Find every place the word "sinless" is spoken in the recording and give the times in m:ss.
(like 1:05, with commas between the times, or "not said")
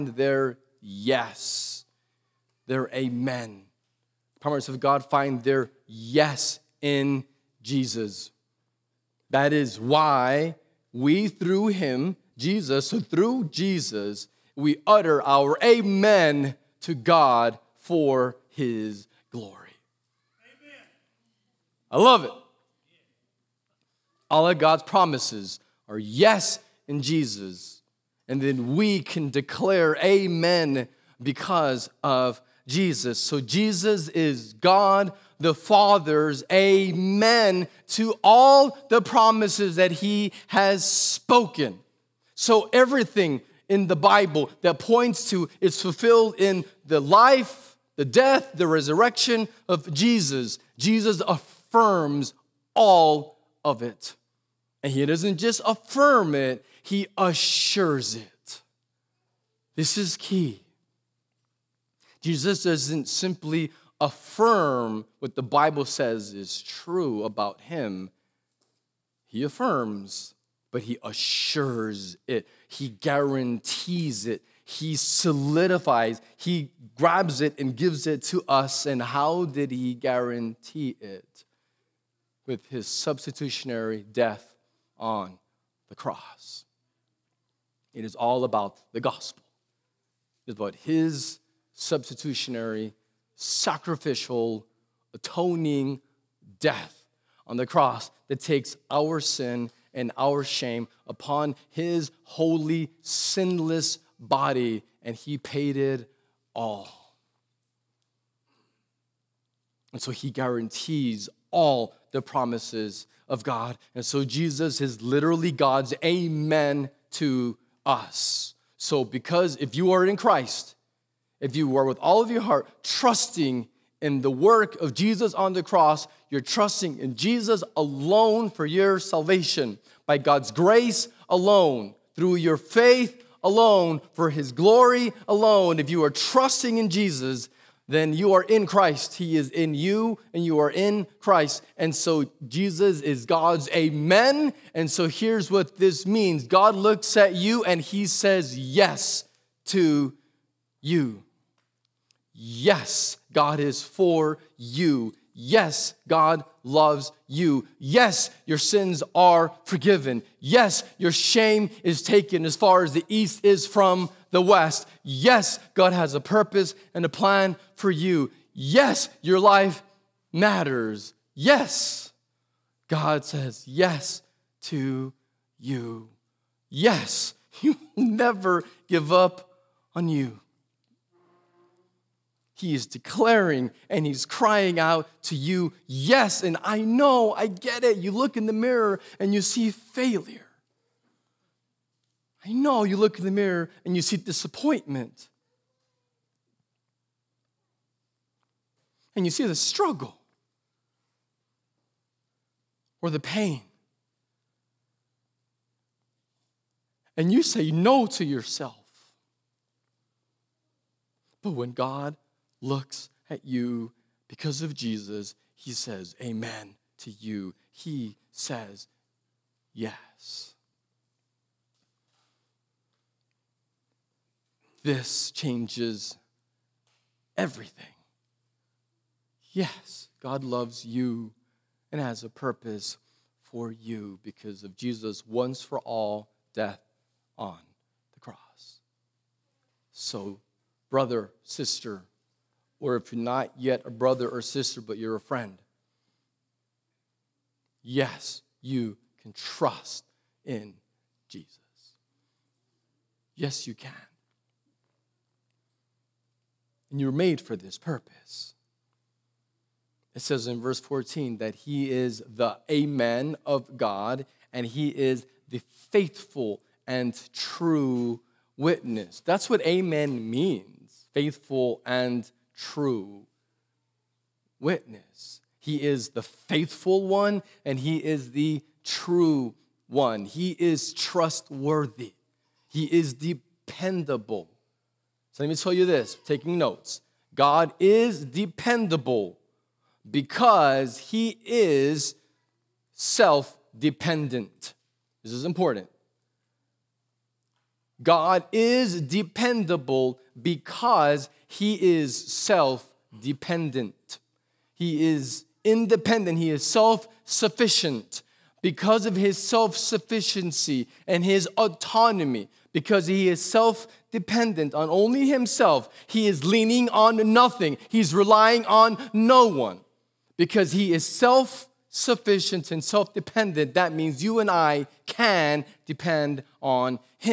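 1:43.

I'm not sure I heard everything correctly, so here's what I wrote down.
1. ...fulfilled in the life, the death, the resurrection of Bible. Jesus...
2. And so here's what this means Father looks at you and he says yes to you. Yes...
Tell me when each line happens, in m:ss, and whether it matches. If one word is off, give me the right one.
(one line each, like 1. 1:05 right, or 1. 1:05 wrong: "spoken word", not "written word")
1. 0:45 wrong: "Jesus", not "Bible"
2. 2:24 wrong: "God", not "Father".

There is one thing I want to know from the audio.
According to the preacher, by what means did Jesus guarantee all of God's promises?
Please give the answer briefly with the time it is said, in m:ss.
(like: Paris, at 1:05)
substitutionary death on the cross, at 1:22.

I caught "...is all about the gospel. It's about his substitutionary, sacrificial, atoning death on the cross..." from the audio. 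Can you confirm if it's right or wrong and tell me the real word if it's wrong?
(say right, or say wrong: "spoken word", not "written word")
right.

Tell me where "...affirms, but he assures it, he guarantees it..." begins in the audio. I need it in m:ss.
1:09.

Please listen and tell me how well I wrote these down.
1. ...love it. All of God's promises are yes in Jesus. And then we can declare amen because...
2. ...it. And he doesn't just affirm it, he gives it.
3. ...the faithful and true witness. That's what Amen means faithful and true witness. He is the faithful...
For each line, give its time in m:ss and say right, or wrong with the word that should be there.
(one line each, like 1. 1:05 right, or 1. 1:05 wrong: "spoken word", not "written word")
1. 0:22 right
2. 0:53 wrong: "assures", not "gives"
3. 4:25 right.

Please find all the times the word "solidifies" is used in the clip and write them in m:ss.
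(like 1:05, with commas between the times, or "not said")
1:14.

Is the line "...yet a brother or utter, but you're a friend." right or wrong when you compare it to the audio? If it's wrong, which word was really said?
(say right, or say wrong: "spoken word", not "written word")
wrong: "sister", not "utter".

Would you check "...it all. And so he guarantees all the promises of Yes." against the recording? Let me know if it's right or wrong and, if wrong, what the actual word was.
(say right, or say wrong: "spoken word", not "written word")
wrong: "God", not "Yes".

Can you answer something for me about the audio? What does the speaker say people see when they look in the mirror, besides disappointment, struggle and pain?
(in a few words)
failure.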